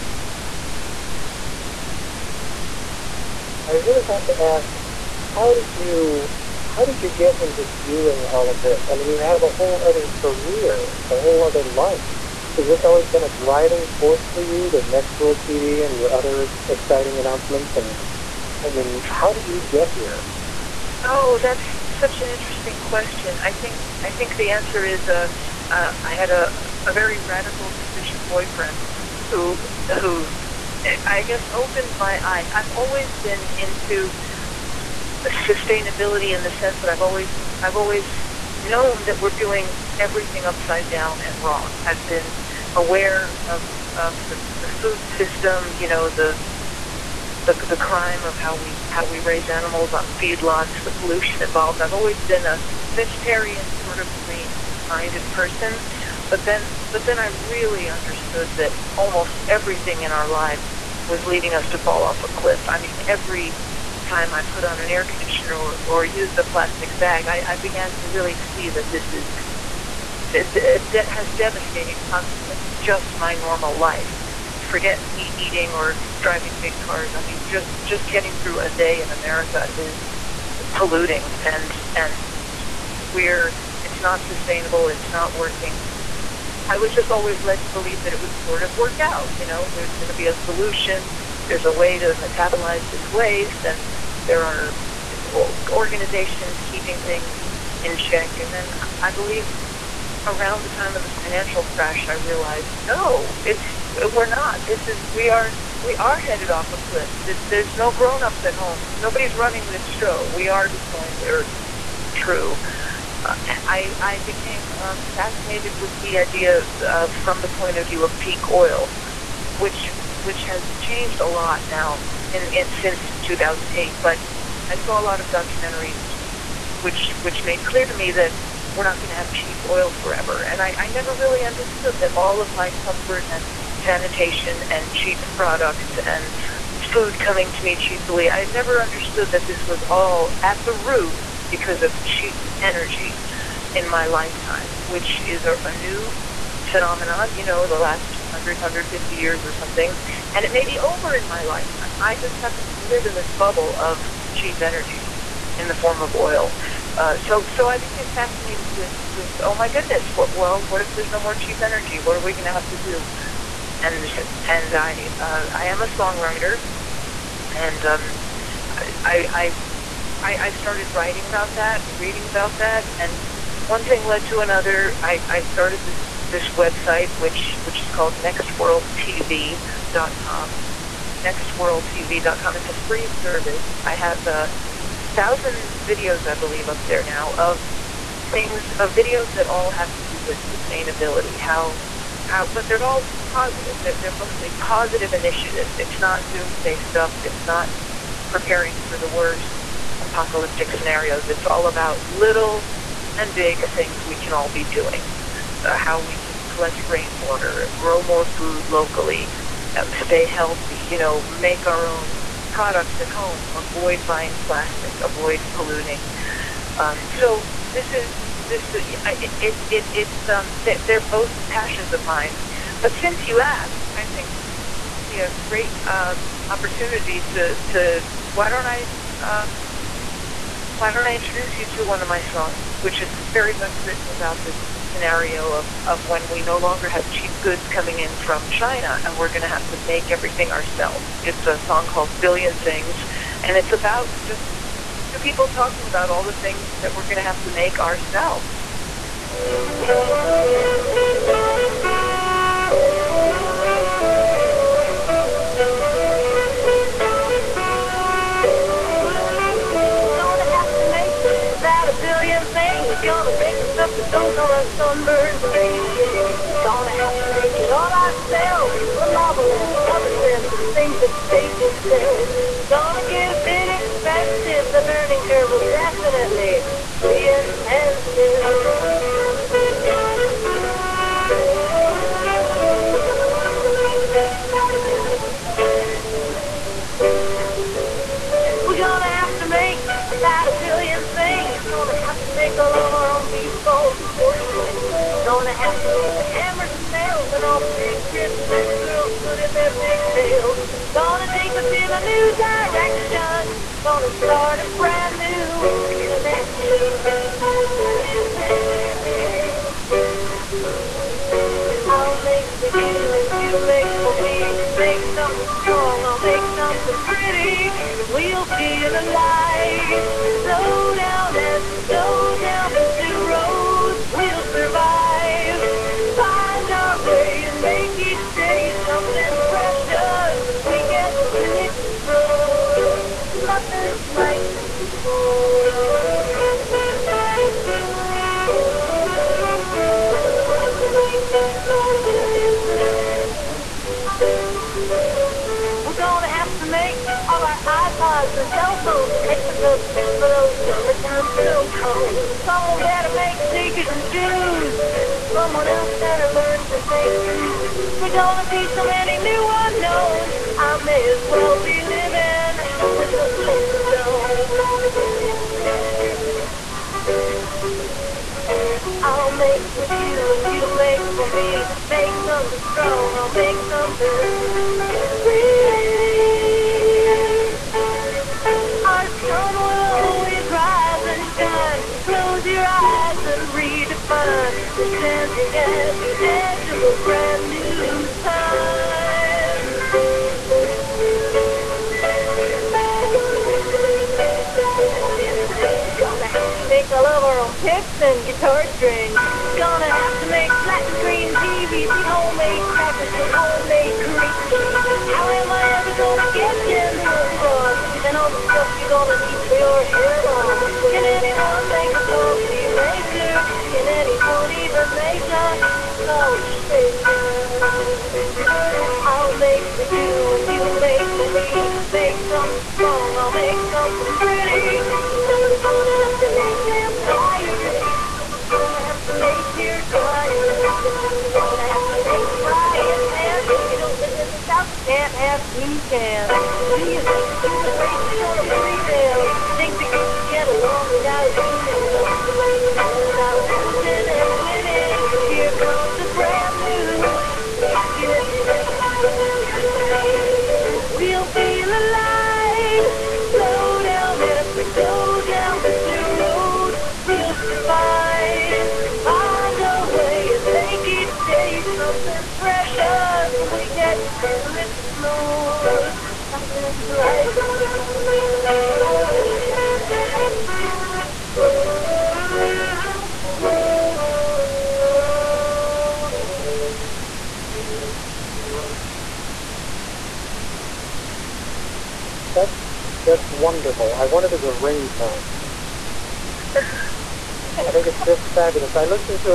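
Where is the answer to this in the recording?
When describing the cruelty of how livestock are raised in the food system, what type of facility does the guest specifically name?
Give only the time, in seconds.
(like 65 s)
50 s.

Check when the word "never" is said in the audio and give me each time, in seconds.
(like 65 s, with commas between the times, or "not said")
130 s, 138 s.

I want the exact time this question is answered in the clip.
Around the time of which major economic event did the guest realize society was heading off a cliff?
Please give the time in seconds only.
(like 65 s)
101 s.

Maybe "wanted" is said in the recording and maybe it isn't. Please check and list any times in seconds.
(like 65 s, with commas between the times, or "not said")
484 s.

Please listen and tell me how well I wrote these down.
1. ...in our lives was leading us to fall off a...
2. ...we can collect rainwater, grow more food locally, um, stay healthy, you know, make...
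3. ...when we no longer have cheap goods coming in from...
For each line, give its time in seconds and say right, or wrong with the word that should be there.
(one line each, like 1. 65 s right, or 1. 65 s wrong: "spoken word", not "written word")
1. 60 s right
2. 205 s right
3. 236 s right.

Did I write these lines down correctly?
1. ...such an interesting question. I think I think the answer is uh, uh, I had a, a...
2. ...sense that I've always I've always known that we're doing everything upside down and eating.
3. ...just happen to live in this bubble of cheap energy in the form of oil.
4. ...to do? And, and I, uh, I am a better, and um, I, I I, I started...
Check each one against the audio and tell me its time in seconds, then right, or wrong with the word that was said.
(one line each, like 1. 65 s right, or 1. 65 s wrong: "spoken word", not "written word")
1. 22 s right
2. 36 s wrong: "wrong", not "eating"
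3. 152 s right
4. 162 s wrong: "songwriter", not "better".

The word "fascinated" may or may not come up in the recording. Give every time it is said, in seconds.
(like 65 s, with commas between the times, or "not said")
115 s, 158 s.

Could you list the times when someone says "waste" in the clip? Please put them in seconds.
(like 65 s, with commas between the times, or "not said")
93 s.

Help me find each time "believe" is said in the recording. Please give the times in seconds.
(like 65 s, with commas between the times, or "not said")
87 s, 99 s, 186 s.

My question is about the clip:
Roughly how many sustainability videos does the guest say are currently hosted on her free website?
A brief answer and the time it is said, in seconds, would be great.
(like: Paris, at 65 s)
1,000, at 184 s.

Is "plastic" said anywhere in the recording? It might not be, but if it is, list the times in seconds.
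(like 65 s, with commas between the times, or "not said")
66 s, 214 s.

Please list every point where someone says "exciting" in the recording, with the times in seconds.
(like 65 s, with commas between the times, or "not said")
16 s.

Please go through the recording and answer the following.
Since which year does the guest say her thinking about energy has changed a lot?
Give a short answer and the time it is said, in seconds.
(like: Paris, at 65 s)
2008, at 123 s.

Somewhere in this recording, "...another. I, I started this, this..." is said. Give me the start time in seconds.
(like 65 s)
174 s.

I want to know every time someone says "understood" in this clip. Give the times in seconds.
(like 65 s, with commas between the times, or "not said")
57 s, 131 s, 138 s.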